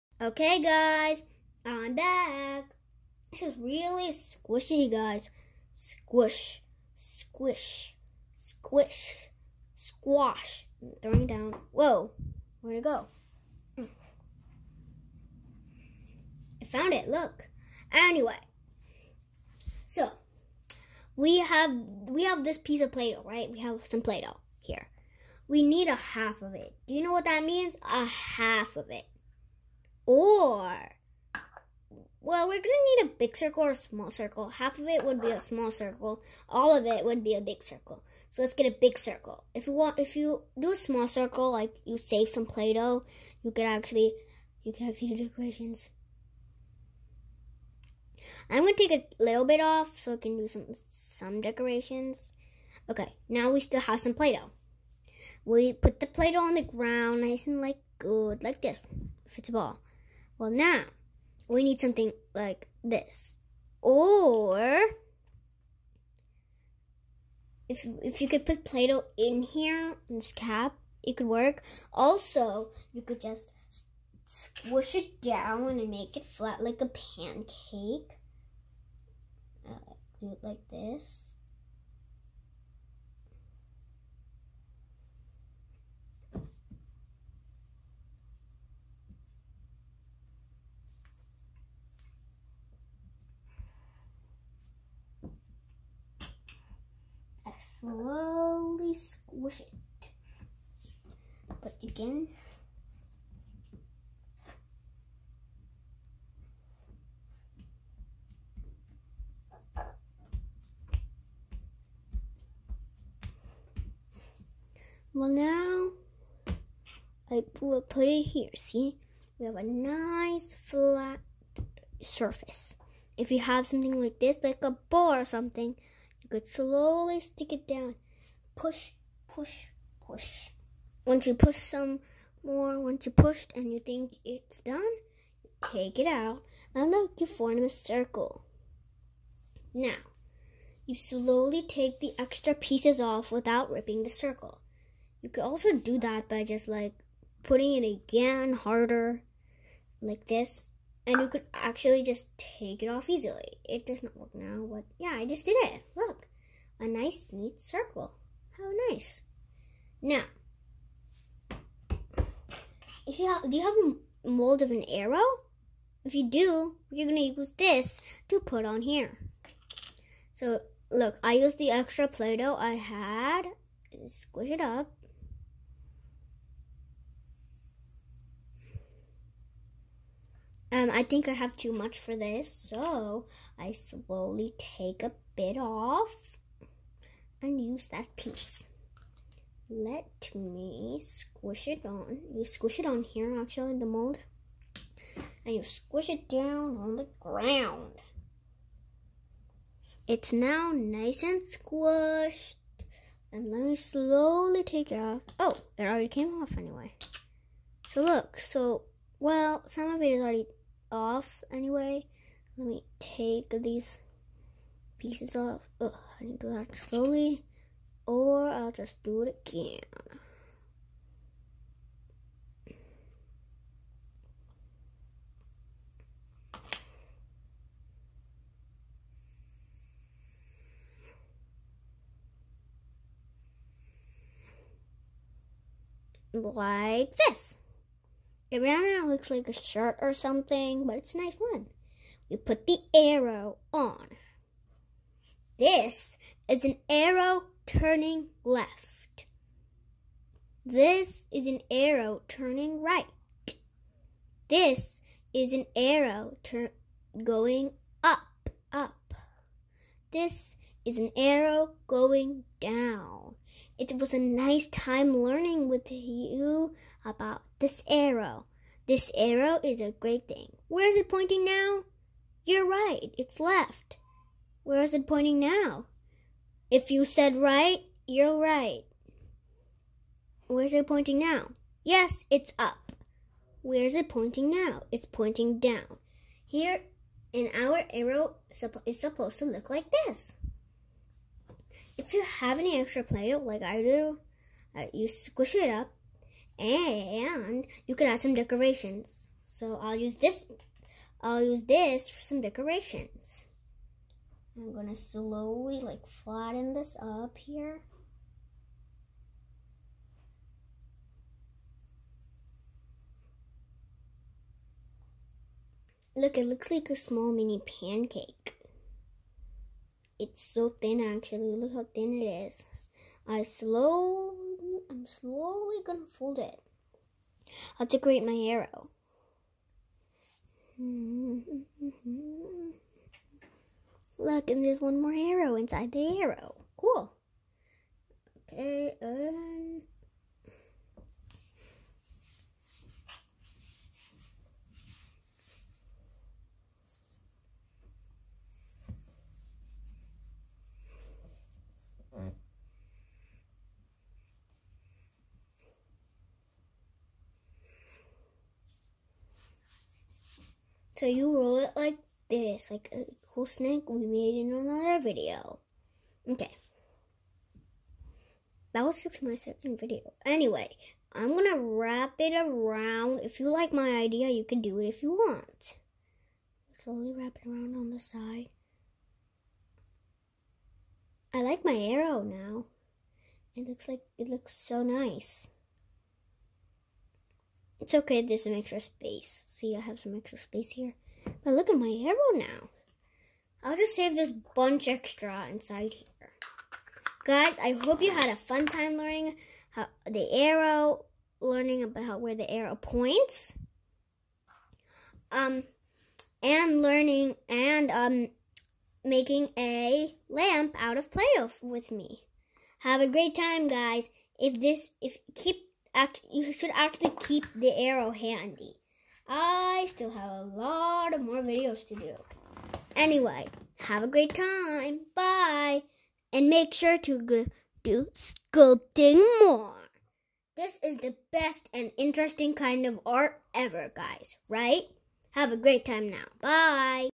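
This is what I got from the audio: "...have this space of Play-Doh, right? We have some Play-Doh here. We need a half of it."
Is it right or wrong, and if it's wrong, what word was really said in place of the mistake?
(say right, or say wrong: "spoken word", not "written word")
wrong: "piece", not "space".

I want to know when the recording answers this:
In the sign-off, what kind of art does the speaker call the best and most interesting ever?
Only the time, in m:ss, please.
7:08.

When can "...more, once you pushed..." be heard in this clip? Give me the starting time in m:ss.
2:12.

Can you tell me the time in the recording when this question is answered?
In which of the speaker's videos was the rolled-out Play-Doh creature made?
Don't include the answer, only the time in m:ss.
6:09.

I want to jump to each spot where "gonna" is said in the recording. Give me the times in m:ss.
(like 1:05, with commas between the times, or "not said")
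5:04, 5:25.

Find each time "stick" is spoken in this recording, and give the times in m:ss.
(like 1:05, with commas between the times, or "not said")
2:07.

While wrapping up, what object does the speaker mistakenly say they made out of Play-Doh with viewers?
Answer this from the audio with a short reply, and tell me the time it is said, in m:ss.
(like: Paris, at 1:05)
a lamp, at 6:49.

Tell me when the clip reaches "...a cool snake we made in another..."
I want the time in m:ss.
6:02.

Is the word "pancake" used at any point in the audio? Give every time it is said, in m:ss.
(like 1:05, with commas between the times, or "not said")
1:16, 5:17.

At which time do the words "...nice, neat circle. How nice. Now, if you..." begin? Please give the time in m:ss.
2:36.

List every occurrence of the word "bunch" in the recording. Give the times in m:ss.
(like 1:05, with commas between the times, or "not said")
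6:34.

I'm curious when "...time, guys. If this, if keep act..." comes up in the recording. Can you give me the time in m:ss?
6:53.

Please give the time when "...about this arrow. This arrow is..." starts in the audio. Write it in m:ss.
4:27.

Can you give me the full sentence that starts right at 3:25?
Oh, it already came off anyway.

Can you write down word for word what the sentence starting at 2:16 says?
And look, you form a circle.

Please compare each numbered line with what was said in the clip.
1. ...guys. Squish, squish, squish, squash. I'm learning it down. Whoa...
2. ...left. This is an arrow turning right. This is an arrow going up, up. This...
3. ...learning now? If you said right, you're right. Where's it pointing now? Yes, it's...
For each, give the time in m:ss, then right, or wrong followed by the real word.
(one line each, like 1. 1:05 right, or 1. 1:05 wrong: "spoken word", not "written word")
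1. 0:04 wrong: "throwing", not "learning"
2. 4:08 right
3. 4:35 wrong: "pointing", not "learning".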